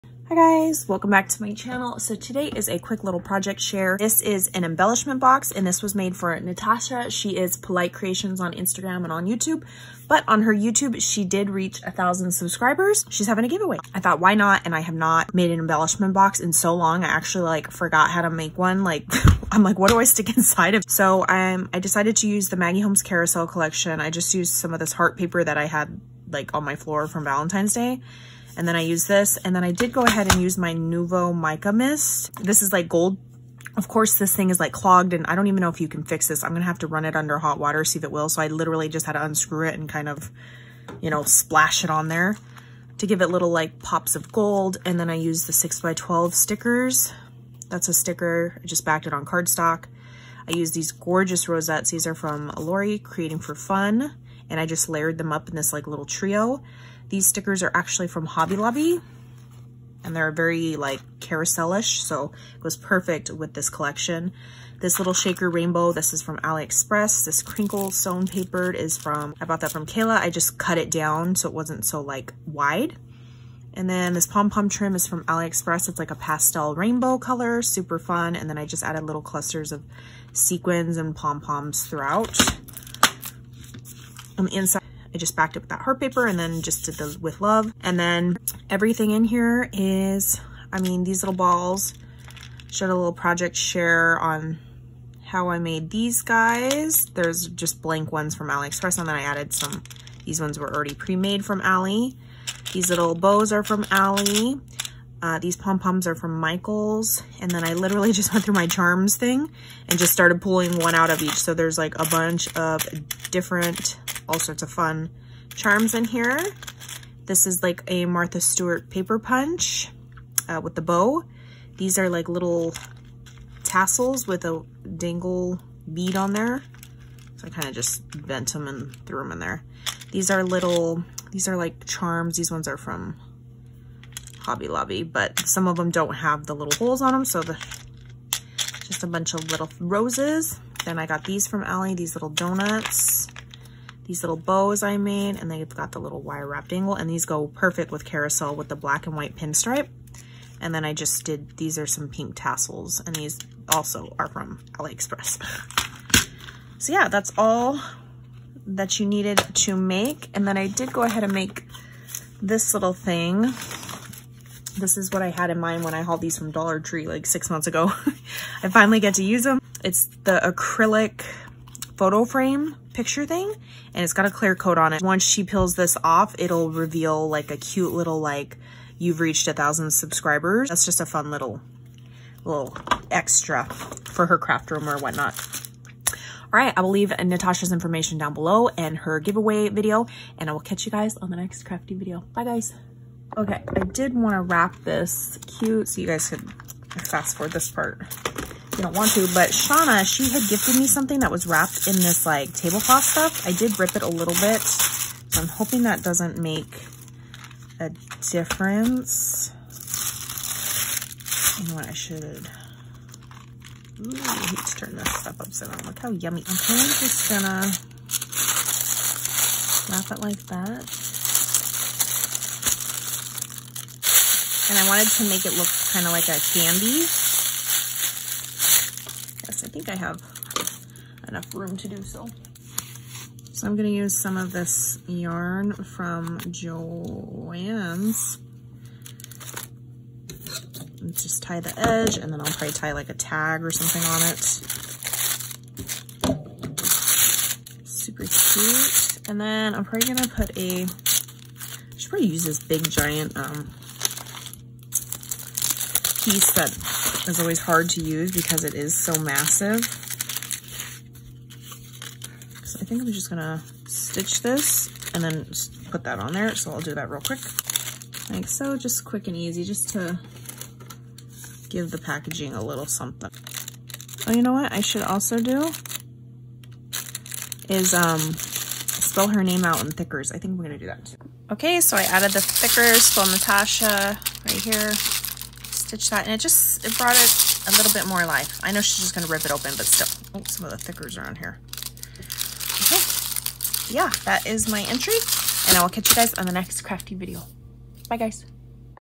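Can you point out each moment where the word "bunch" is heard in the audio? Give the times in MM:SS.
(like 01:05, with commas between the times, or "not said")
01:52, 02:19.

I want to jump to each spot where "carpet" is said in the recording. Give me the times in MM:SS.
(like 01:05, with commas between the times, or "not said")
not said.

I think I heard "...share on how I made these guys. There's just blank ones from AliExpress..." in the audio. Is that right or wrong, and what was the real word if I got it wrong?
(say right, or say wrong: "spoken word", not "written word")
right.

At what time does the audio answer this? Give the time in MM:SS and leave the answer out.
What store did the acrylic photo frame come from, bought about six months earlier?
02:46.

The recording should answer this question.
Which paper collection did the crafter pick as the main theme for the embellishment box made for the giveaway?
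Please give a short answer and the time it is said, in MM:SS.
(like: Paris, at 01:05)
Maggie Holmes Carousel, at 00:22.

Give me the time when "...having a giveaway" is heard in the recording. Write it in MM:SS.
00:13.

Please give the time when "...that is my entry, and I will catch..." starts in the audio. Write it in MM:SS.
04:54.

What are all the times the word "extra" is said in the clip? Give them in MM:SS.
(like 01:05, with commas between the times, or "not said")
03:03.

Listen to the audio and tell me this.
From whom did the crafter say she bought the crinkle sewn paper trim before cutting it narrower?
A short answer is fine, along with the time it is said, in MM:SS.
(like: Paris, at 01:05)
Kayla, at 01:09.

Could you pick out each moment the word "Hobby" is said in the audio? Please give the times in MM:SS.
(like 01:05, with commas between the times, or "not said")
00:58, 02:14.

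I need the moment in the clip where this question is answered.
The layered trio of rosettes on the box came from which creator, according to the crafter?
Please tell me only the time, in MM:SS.
00:52.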